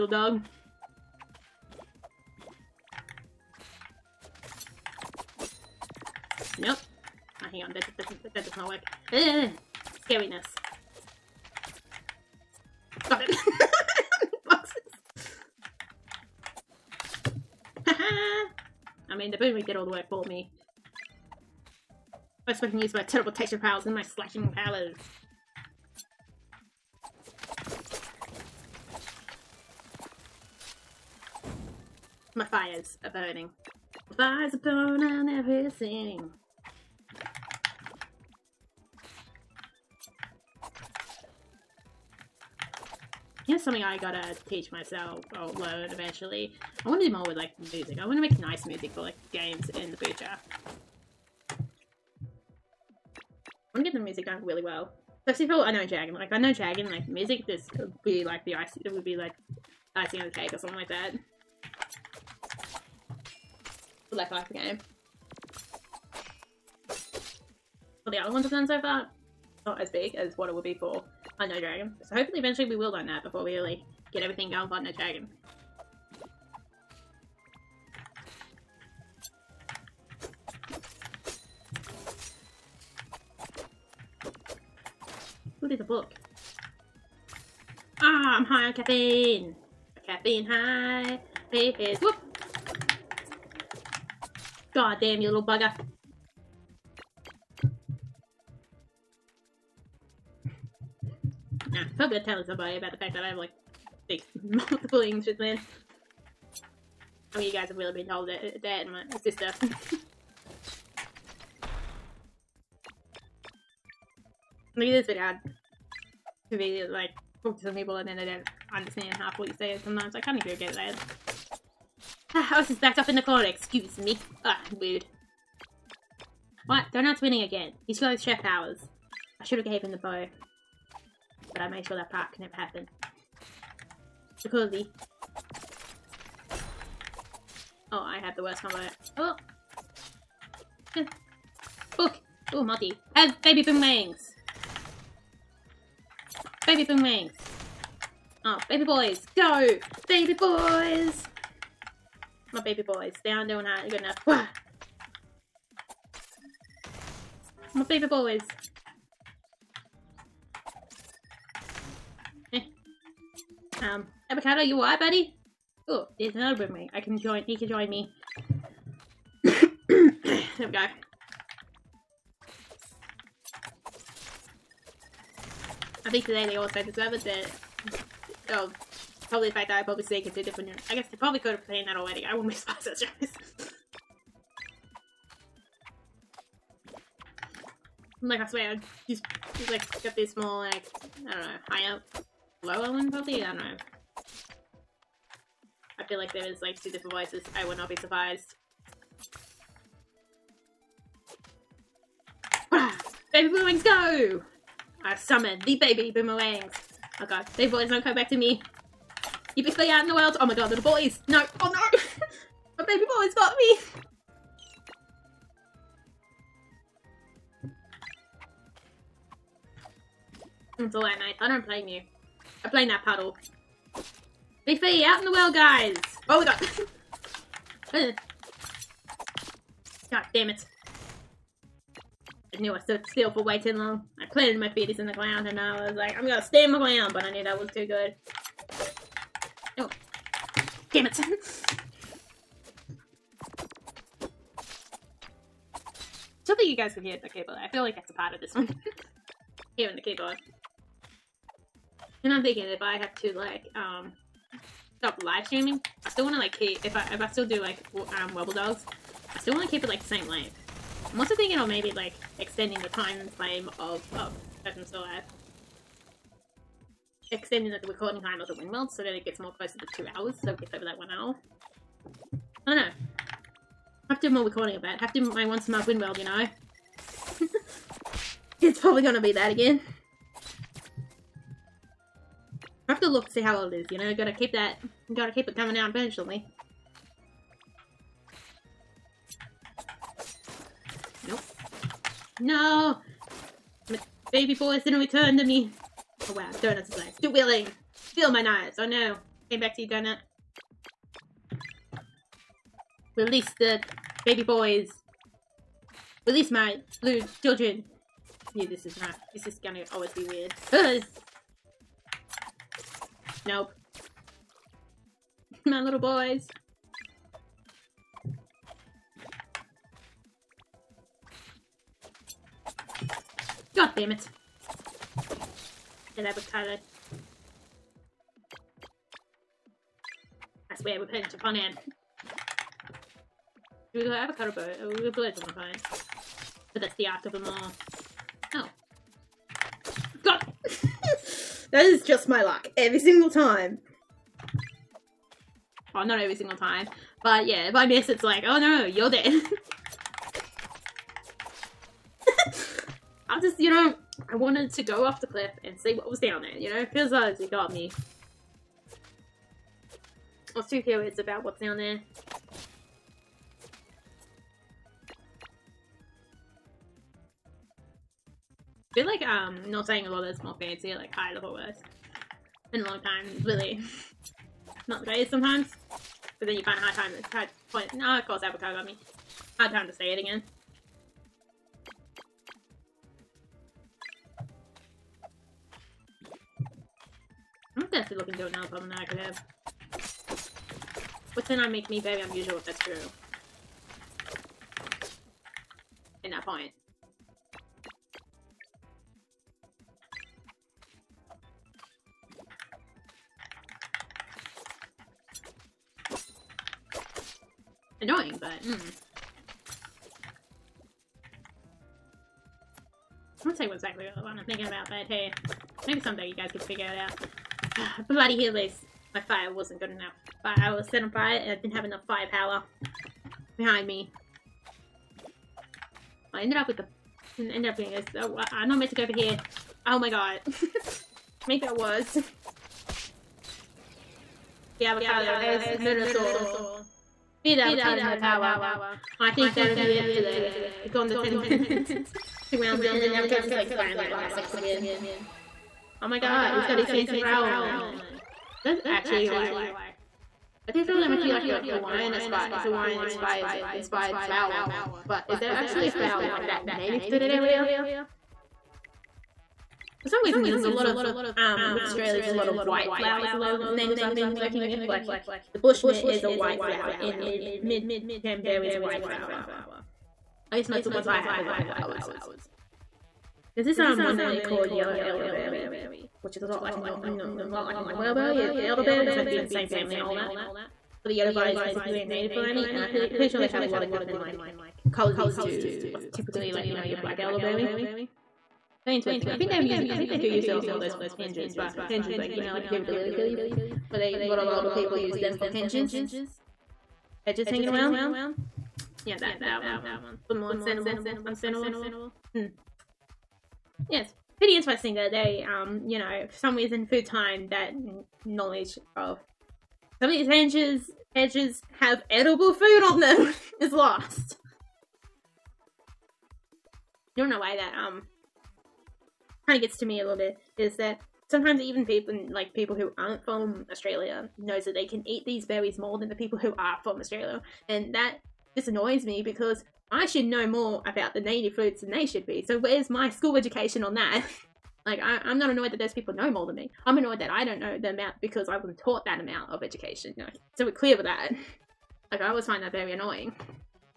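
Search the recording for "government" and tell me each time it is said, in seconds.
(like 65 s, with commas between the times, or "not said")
not said.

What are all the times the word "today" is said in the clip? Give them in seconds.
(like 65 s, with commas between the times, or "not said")
176 s, 440 s.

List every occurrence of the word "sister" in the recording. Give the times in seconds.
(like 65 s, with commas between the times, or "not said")
109 s.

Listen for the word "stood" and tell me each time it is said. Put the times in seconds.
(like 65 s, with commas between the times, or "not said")
232 s.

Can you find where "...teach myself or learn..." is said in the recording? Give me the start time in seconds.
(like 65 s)
44 s.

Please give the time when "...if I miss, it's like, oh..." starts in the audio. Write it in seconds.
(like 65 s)
347 s.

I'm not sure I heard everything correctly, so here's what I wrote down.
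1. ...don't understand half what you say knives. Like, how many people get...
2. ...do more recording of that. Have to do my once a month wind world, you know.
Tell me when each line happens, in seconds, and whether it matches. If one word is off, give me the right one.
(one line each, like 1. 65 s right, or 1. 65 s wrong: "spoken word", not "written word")
1. 118 s wrong: "sometimes", not "knives"
2. 274 s right.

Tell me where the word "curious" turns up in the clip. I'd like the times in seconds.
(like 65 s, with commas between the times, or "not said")
360 s.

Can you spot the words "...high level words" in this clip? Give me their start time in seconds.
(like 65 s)
371 s.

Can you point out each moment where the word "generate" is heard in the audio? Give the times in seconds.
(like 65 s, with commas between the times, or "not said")
not said.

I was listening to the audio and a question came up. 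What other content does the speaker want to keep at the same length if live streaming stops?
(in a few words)
wobble dolls.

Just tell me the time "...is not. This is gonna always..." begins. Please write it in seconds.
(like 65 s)
308 s.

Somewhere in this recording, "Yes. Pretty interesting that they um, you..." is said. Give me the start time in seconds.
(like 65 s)
503 s.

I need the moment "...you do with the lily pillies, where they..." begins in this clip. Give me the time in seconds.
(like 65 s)
492 s.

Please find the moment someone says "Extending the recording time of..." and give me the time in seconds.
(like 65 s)
267 s.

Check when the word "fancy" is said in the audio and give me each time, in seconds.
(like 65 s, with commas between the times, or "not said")
370 s, 446 s.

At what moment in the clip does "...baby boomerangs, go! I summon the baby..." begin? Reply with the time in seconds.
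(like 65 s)
203 s.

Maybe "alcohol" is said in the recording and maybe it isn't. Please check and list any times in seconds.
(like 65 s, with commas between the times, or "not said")
not said.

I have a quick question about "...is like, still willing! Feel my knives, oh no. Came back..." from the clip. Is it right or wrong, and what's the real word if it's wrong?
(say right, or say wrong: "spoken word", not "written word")
right.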